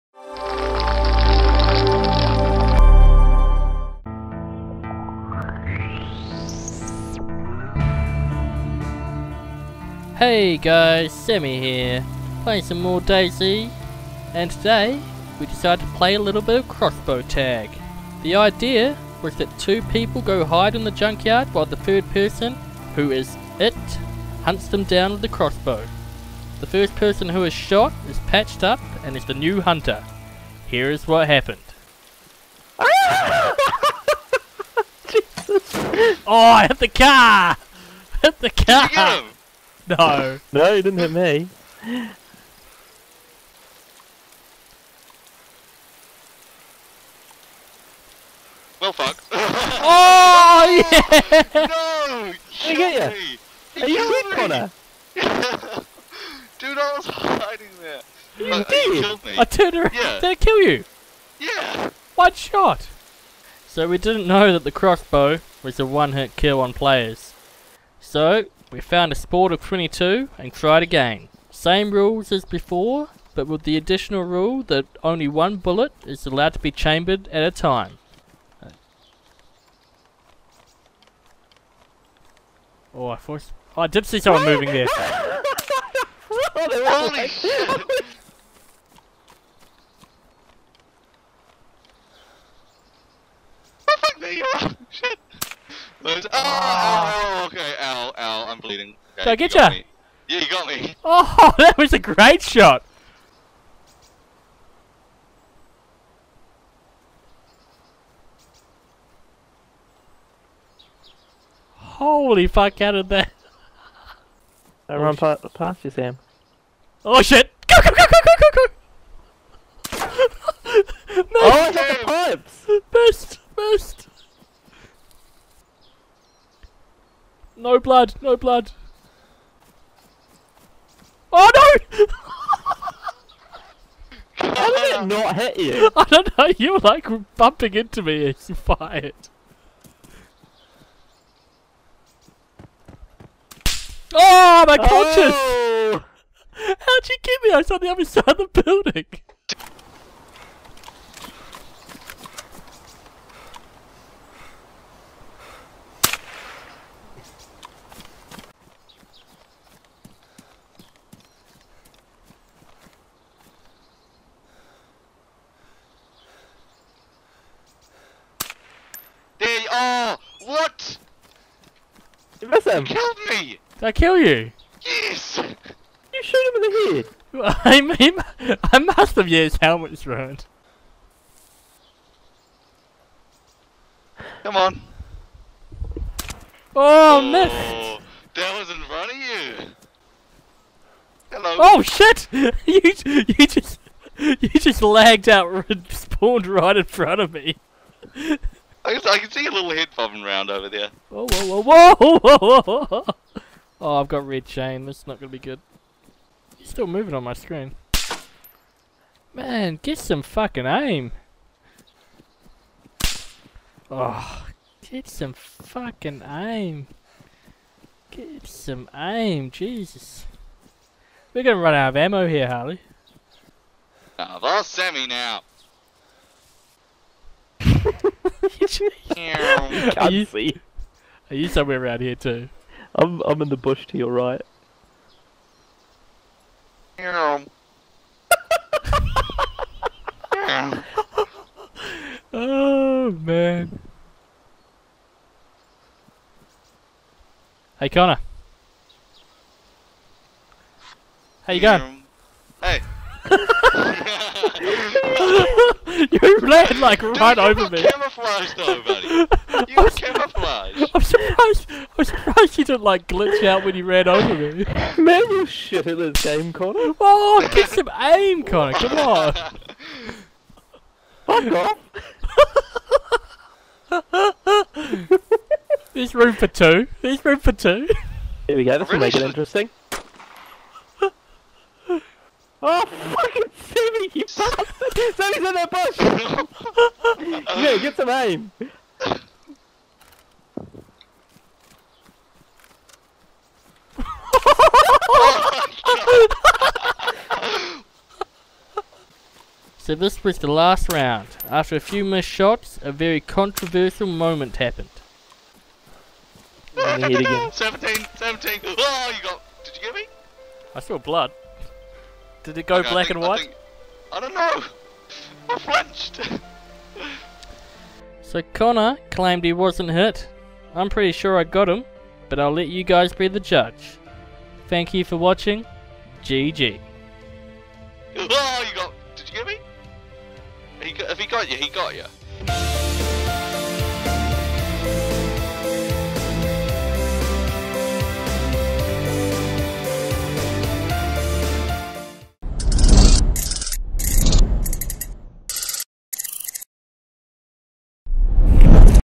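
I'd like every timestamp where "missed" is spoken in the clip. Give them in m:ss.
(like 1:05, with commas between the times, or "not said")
3:07, 5:02.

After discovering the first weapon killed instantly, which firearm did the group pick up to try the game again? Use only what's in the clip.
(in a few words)
Sporter 22.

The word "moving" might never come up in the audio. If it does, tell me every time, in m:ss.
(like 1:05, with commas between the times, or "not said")
1:24, 3:26.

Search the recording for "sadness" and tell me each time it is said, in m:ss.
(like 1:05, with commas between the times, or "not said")
not said.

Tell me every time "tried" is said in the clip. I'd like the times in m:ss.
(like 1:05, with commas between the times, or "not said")
1:10.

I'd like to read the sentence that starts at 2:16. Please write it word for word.
You were like bumping into me as you fired.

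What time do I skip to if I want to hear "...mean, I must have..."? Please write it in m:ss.
2:57.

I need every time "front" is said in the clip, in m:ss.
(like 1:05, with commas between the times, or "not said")
3:08, 3:16.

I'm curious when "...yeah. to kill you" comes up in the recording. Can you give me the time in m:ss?
0:59.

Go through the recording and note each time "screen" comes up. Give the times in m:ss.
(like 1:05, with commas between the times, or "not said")
3:27.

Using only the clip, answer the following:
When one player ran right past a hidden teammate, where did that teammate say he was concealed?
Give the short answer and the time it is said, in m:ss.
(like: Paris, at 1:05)
In the bush, at 3:53.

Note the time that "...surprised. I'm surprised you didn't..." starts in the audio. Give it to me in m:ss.
4:21.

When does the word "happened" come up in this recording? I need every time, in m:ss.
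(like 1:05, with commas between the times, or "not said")
0:31, 5:04.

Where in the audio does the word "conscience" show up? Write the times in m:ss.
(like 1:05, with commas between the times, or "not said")
2:24.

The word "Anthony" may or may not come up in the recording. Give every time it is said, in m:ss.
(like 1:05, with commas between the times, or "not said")
not said.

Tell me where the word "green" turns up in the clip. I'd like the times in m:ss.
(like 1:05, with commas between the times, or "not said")
not said.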